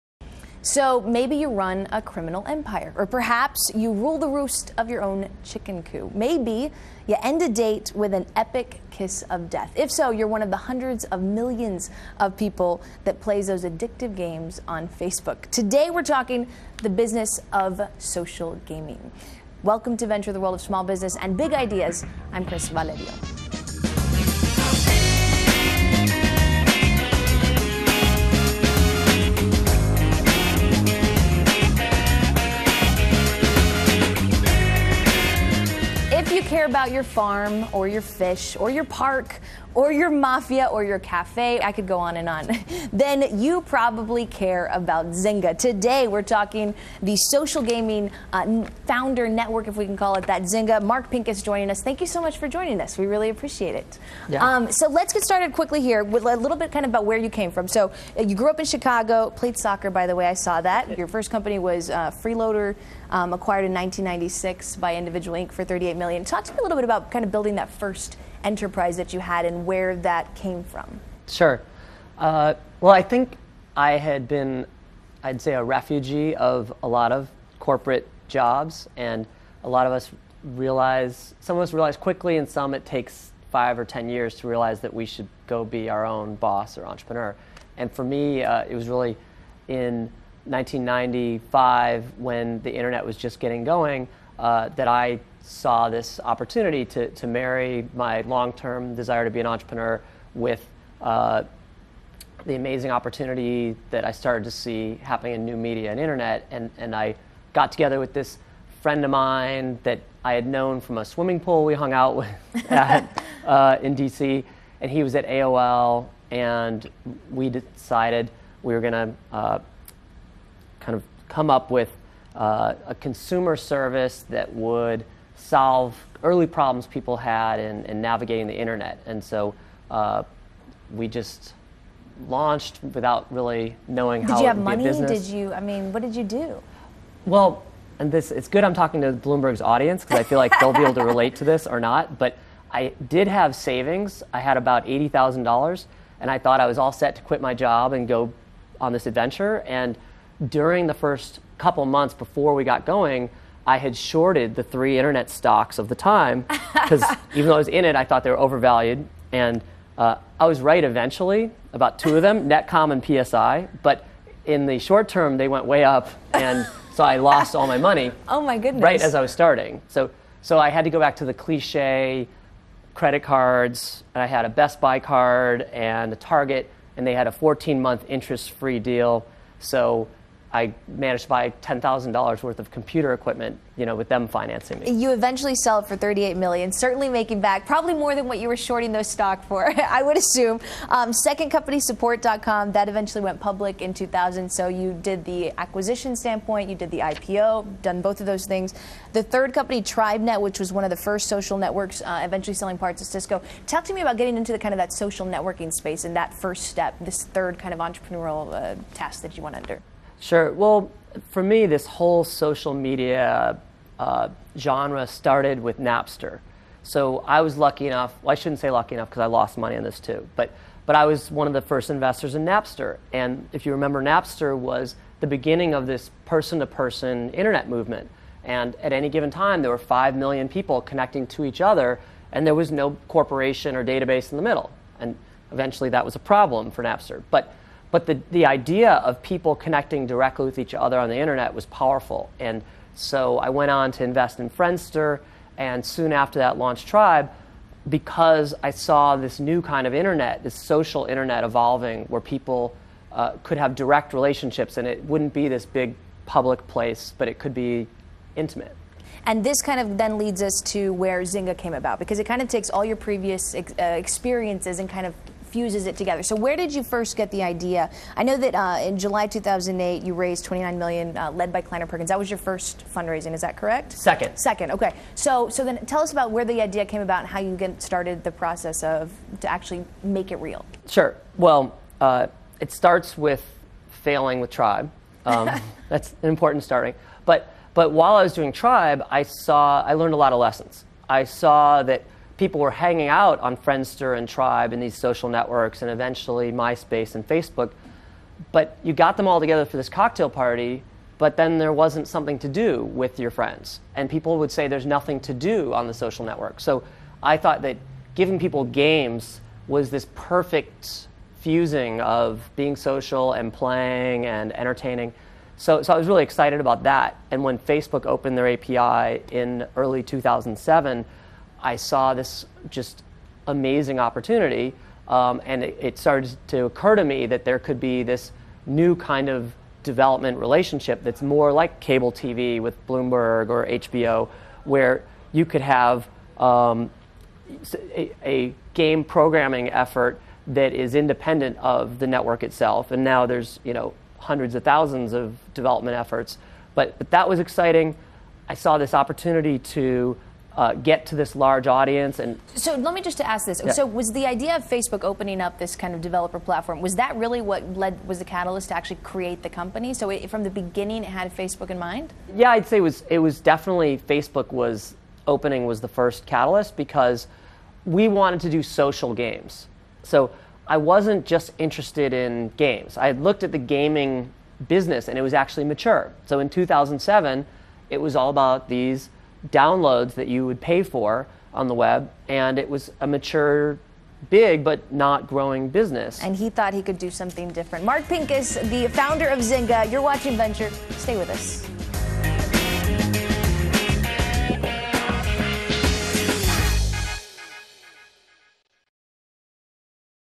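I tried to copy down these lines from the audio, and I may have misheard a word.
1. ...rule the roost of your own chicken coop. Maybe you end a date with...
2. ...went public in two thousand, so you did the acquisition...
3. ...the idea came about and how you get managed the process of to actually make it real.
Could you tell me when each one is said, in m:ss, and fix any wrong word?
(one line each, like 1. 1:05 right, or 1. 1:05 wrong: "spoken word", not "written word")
1. 0:03 right
2. 3:13 right
3. 4:36 wrong: "started", not "managed".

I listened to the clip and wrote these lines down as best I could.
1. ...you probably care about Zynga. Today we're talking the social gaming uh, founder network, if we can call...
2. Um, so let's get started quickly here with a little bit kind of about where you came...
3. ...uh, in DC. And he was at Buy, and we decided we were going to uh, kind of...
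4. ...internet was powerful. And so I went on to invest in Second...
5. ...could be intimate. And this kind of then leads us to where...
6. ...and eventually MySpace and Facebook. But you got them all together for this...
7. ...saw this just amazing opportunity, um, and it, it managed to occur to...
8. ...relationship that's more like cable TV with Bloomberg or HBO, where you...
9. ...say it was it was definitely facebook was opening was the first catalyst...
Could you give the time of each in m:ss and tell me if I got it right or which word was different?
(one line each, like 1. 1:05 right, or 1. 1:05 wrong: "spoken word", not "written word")
1. 0:43 right
2. 0:54 right
3. 1:53 wrong: "AOL", not "Buy"
4. 4:01 wrong: "Friendster", not "Second"
5. 4:17 right
6. 4:55 right
7. 5:21 wrong: "started", not "managed"
8. 5:30 right
9. 6:02 right.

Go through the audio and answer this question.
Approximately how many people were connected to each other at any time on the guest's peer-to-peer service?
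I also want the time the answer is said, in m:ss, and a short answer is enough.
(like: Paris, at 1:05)
5 million, at 3:49.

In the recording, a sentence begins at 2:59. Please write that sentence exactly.
So I managed to buy ten thousand dollars worth of computer equipment, you know, with them financing me.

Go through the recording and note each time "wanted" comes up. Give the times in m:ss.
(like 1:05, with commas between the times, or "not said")
6:08.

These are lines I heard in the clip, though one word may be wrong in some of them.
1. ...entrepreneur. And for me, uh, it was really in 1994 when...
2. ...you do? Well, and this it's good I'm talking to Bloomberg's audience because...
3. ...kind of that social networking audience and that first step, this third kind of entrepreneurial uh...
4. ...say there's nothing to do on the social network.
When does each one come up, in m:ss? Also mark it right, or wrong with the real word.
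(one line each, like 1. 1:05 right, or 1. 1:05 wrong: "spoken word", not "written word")
1. 1:26 wrong: "1995", not "1994"
2. 2:16 right
3. 3:24 wrong: "space", not "audience"
4. 5:04 right.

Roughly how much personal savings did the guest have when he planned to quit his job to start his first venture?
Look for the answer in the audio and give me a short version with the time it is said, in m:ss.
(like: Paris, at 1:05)
$80,000, at 2:24.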